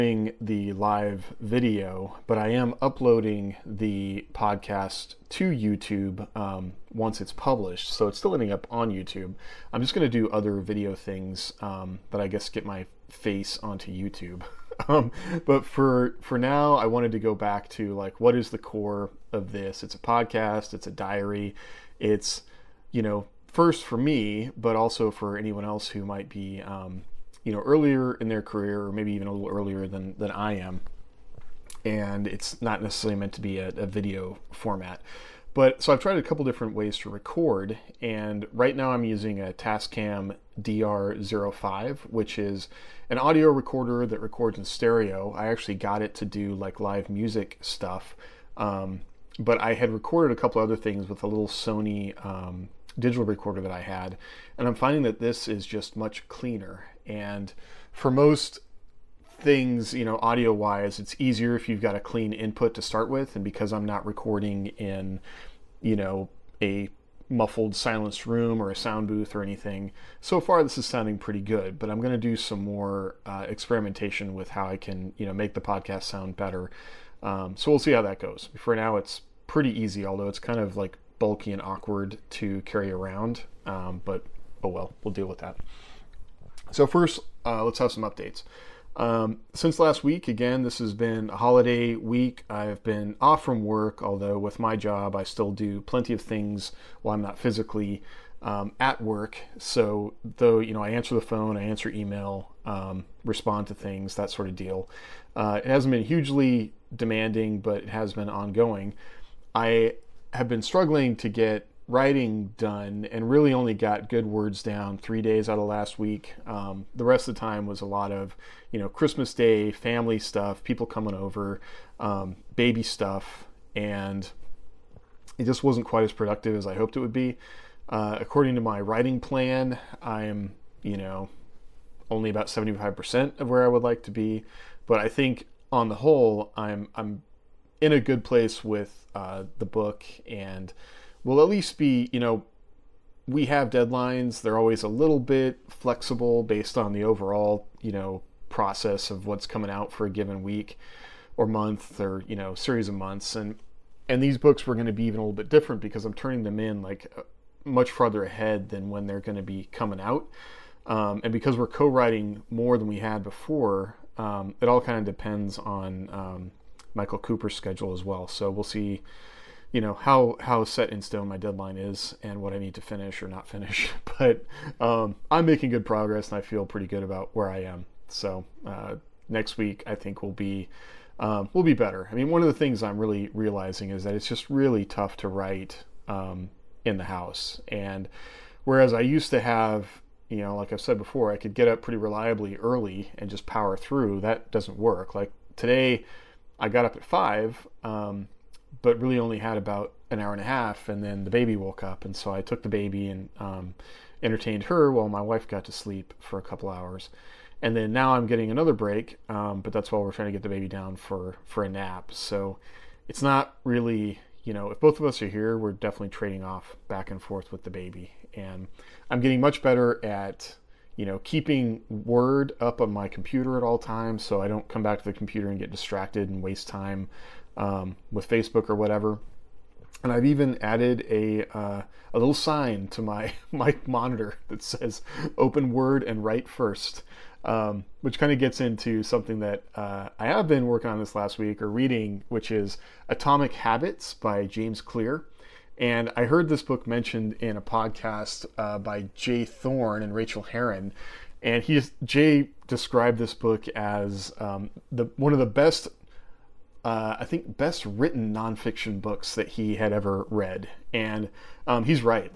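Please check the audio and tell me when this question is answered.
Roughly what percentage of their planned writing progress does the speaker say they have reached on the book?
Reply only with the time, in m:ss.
2:12.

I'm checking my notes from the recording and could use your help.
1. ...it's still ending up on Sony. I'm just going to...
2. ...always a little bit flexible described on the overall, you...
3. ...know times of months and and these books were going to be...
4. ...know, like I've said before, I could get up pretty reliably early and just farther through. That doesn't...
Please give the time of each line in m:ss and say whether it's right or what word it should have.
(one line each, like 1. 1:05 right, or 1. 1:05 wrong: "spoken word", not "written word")
1. 0:08 wrong: "YouTube", not "Sony"
2. 2:24 wrong: "based", not "described"
3. 2:32 wrong: "series", not "times"
4. 3:10 wrong: "power", not "farther".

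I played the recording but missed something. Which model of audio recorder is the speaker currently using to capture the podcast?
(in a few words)
Tascam DR05.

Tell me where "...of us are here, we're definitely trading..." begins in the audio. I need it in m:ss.
3:34.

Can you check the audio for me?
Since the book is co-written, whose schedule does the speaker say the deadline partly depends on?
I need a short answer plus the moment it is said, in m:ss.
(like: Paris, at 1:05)
Michael Cooper, at 2:46.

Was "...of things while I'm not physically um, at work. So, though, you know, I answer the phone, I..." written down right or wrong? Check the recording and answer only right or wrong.
right.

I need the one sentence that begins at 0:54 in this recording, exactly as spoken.
And I'm finding that this is just much cleaner.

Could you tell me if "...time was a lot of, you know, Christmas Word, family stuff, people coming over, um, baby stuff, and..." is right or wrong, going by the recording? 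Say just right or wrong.
wrong.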